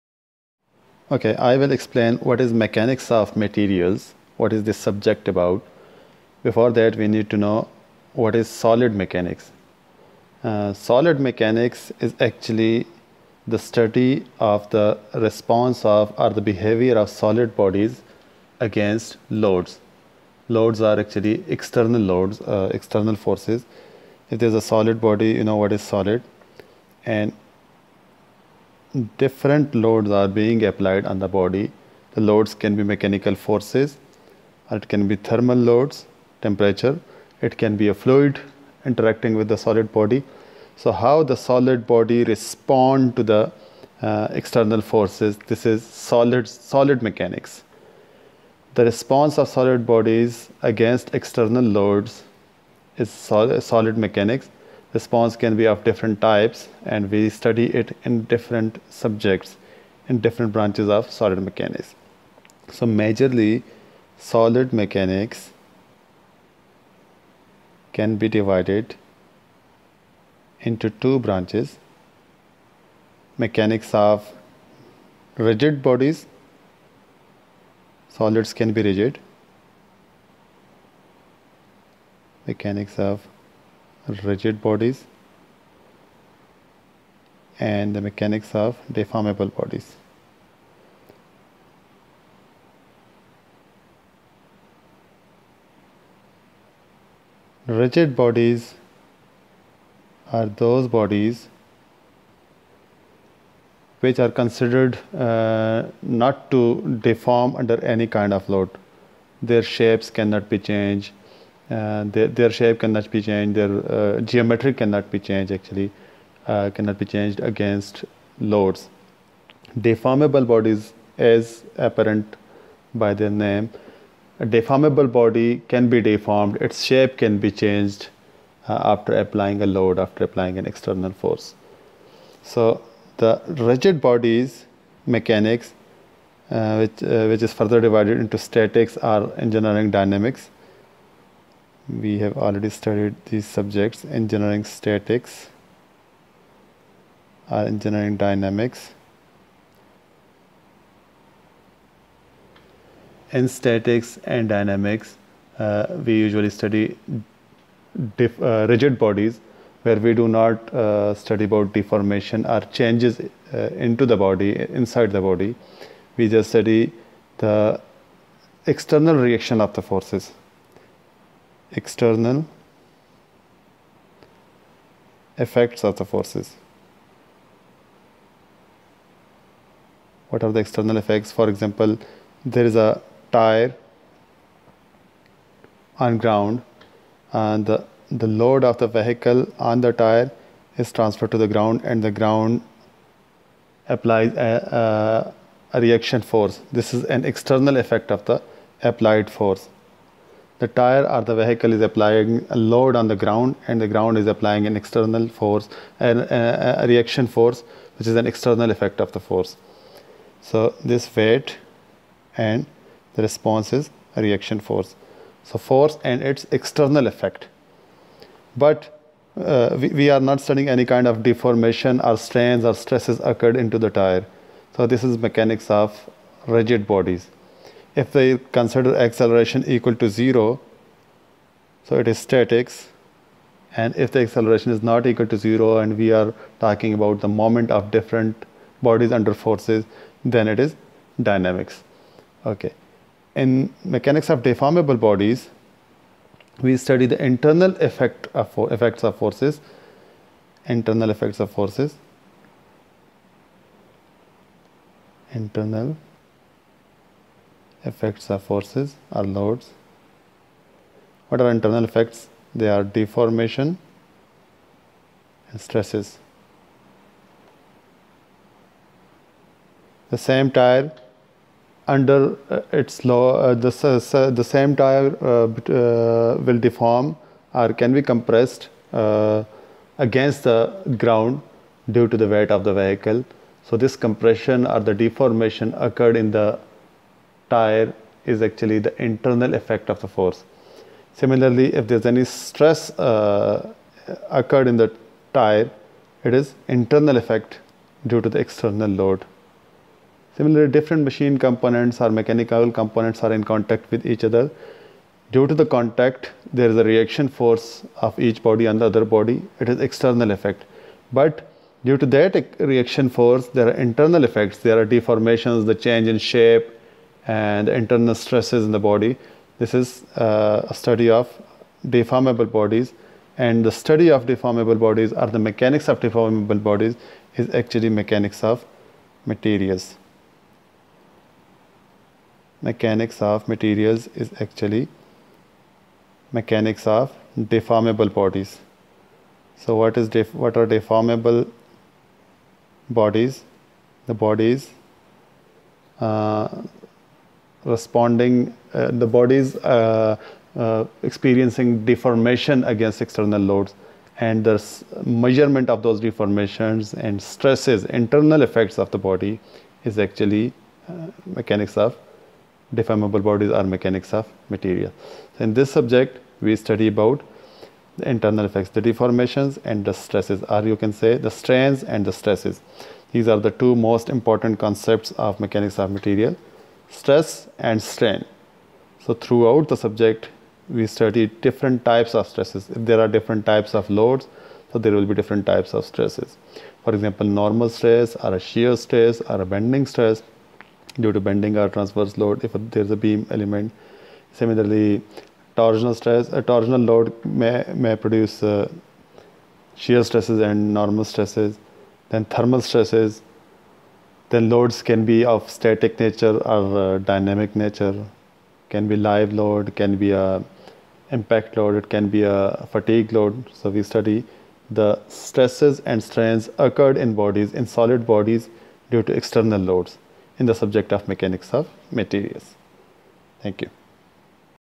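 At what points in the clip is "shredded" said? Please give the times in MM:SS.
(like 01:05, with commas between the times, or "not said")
not said.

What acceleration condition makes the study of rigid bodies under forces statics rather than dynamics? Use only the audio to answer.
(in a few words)
acceleration equal to zero.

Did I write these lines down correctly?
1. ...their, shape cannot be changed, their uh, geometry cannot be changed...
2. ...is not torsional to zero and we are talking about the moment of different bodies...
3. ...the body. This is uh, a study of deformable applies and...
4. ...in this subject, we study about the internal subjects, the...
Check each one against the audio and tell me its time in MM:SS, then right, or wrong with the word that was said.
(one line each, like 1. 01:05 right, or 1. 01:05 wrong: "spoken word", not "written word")
1. 01:52 right
2. 03:54 wrong: "equal", not "torsional"
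3. 05:18 wrong: "bodies", not "applies"
4. 06:05 wrong: "effects", not "subjects".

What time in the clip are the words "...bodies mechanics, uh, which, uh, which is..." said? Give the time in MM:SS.
02:14.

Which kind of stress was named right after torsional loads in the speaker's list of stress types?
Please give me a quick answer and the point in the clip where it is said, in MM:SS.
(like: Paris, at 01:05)
thermal stresses, at 06:42.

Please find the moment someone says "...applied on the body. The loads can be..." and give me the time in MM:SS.
00:30.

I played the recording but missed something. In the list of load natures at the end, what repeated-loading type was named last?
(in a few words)
fatigue load.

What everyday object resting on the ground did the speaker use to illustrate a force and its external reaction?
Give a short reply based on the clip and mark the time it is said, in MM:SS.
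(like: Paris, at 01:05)
a tire, at 03:02.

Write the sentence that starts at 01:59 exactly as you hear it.
Deformable bodies as apparent by their name.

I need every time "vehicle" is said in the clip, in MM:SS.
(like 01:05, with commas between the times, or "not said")
03:08, 03:21, 04:42.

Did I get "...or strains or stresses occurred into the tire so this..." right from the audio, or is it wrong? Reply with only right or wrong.
right.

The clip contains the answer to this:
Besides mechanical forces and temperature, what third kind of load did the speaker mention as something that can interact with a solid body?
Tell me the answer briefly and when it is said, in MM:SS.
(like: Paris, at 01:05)
a fluid, at 00:37.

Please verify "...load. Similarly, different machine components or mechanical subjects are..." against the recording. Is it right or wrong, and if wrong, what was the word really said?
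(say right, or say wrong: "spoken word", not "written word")
wrong: "components", not "subjects".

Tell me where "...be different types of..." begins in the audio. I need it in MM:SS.
06:25.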